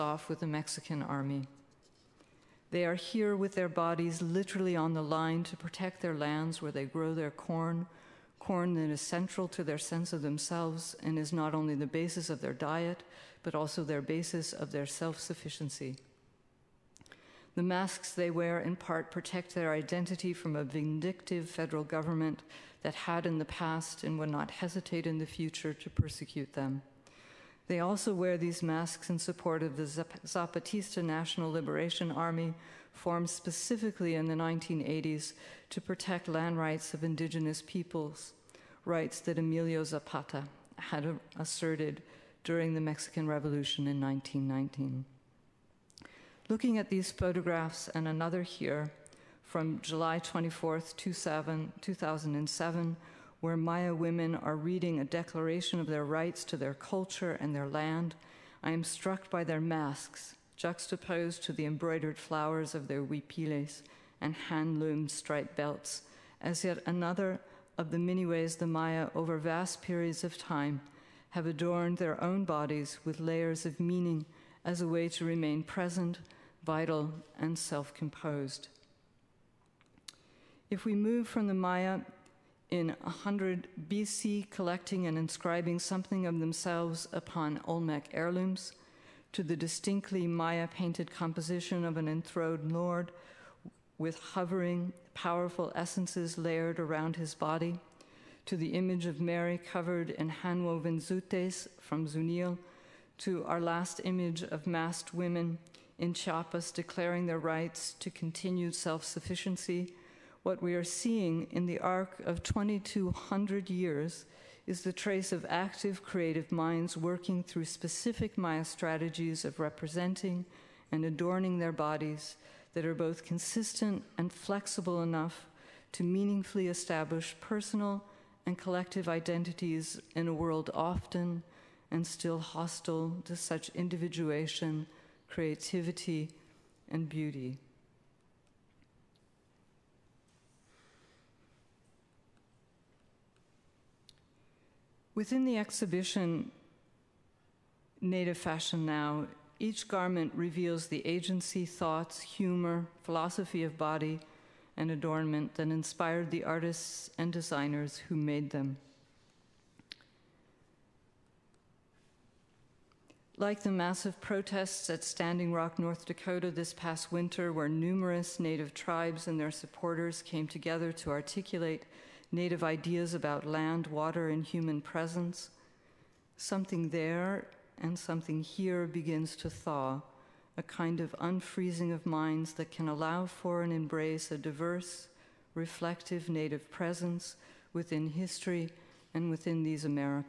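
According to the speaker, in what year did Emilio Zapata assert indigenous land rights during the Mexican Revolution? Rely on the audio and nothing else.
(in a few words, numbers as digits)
1919.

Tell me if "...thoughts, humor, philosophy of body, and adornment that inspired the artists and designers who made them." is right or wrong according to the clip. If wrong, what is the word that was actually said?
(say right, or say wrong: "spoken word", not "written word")
right.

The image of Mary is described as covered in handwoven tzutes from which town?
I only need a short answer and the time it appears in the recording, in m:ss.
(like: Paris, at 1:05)
Zunil, at 1:42.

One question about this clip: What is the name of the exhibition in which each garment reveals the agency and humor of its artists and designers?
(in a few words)
Native Fashion Now.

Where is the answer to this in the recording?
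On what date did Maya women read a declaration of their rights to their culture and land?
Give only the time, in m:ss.
0:49.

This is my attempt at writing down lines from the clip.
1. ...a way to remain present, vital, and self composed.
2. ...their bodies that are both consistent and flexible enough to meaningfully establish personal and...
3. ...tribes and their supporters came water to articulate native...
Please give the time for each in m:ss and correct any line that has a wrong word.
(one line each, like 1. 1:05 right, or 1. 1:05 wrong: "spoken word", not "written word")
1. 1:14 right
2. 2:01 right
3. 2:48 wrong: "together", not "water".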